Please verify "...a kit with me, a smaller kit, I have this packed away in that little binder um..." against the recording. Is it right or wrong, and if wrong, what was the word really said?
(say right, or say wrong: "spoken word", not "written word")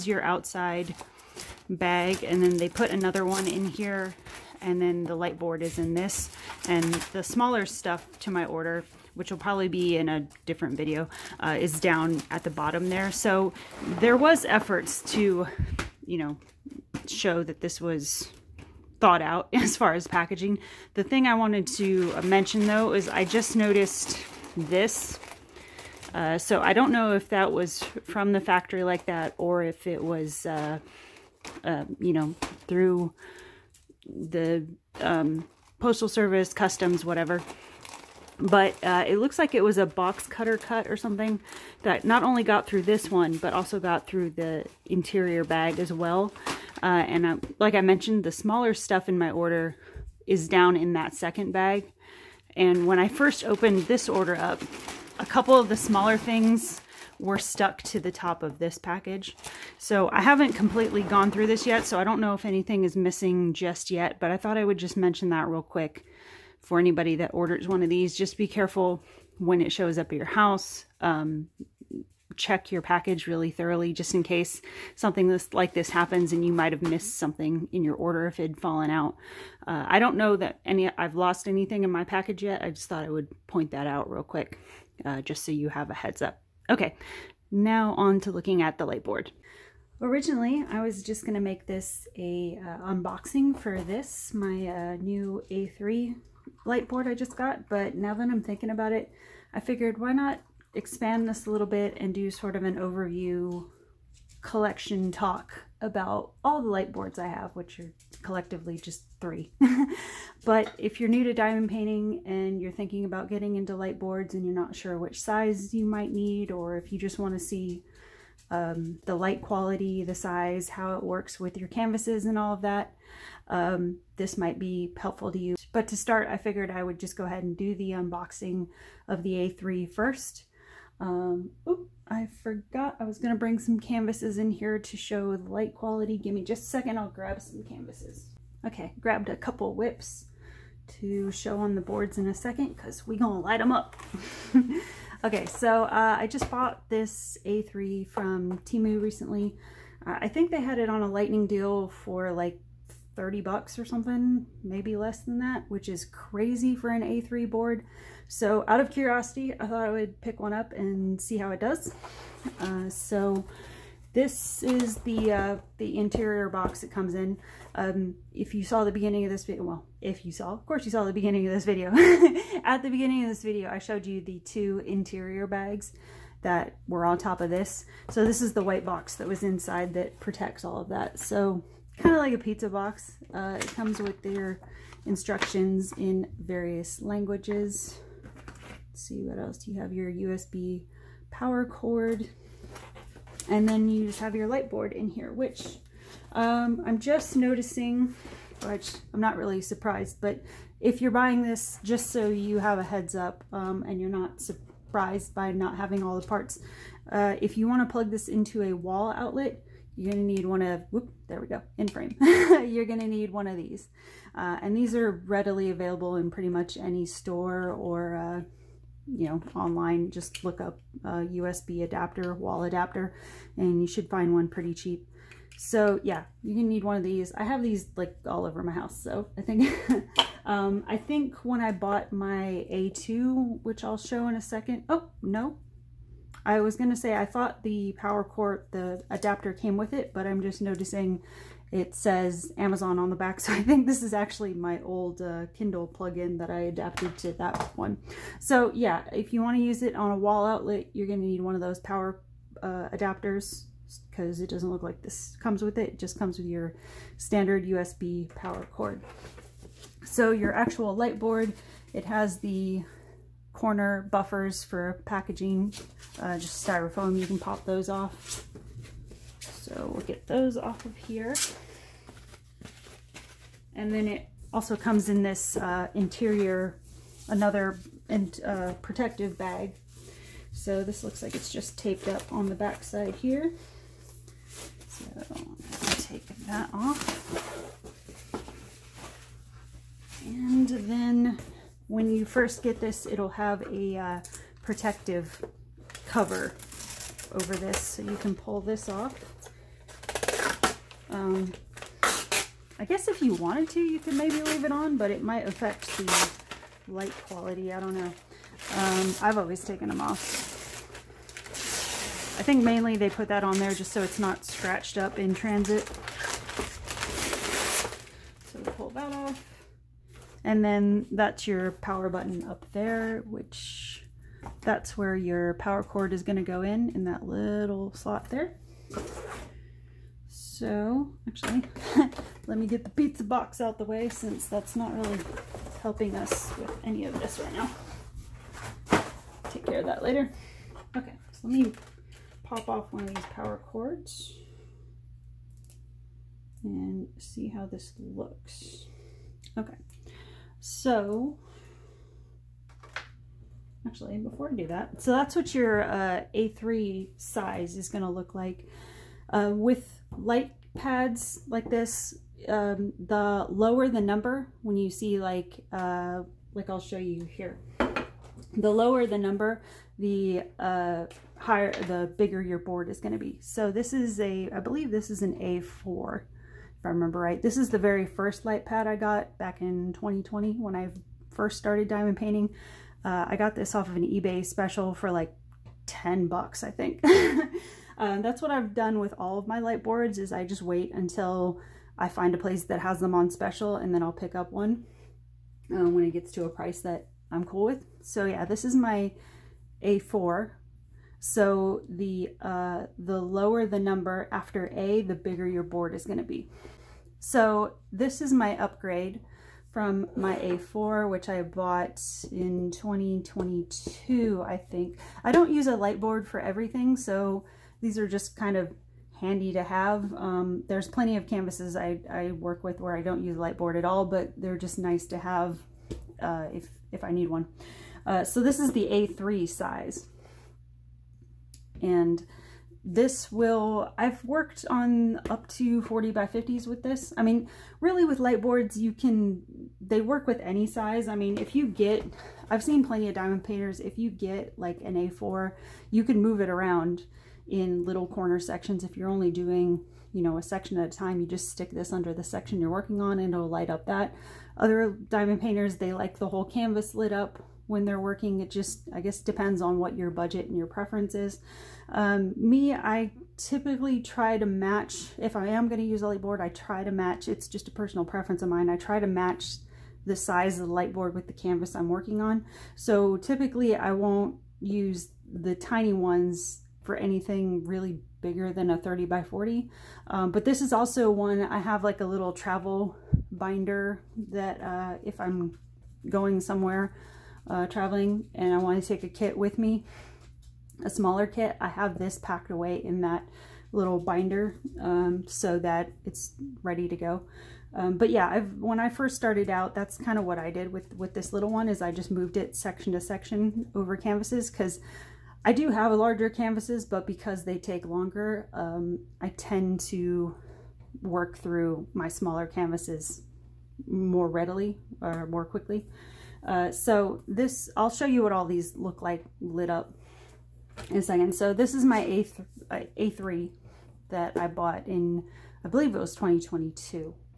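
right.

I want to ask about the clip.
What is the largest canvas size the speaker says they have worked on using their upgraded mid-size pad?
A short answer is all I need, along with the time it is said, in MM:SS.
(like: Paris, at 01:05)
40 by 50, at 07:15.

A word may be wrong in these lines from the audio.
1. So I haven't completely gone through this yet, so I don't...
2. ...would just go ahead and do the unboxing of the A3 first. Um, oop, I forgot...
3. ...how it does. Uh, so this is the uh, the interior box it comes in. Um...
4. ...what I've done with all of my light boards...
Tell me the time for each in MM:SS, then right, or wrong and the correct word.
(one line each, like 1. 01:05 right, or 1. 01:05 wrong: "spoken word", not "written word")
1. 00:59 right
2. 02:06 right
3. 02:41 right
4. 06:28 right.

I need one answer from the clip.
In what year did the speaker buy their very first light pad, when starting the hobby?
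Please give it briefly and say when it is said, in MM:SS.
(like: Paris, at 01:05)
2020, at 06:19.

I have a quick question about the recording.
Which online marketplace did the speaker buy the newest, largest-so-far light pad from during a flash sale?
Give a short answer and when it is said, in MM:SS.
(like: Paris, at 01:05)
Temu, at 02:28.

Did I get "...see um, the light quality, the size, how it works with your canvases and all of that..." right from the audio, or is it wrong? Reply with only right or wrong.
right.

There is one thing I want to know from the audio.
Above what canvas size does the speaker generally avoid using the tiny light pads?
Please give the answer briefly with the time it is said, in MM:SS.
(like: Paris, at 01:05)
30 by 40, at 07:58.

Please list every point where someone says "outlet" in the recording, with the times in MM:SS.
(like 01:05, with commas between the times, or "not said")
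03:29, 04:10.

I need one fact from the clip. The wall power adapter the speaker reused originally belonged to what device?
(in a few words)
Kindle.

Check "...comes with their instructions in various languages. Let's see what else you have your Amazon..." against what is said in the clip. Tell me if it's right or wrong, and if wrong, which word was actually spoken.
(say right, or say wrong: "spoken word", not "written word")
wrong: "USB", not "Amazon".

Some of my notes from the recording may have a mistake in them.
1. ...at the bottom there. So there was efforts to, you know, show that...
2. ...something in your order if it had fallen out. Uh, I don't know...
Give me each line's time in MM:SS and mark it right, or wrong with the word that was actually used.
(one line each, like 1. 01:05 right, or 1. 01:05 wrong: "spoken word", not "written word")
1. 00:12 right
2. 01:17 right.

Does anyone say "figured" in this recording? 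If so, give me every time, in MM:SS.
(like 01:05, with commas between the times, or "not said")
01:39, 02:06.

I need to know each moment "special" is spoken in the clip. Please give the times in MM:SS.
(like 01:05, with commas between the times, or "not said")
06:24, 06:33.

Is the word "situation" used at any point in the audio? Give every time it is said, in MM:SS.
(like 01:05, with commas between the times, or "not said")
not said.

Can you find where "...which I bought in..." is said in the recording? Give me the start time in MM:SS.
06:51.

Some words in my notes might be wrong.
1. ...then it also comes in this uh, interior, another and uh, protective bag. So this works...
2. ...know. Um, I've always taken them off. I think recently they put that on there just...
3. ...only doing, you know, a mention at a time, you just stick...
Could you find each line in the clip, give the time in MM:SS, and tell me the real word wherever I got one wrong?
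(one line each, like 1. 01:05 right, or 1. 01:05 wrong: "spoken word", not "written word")
1. 04:33 wrong: "looks", not "works"
2. 05:07 wrong: "mainly", not "recently"
3. 07:29 wrong: "section", not "mention".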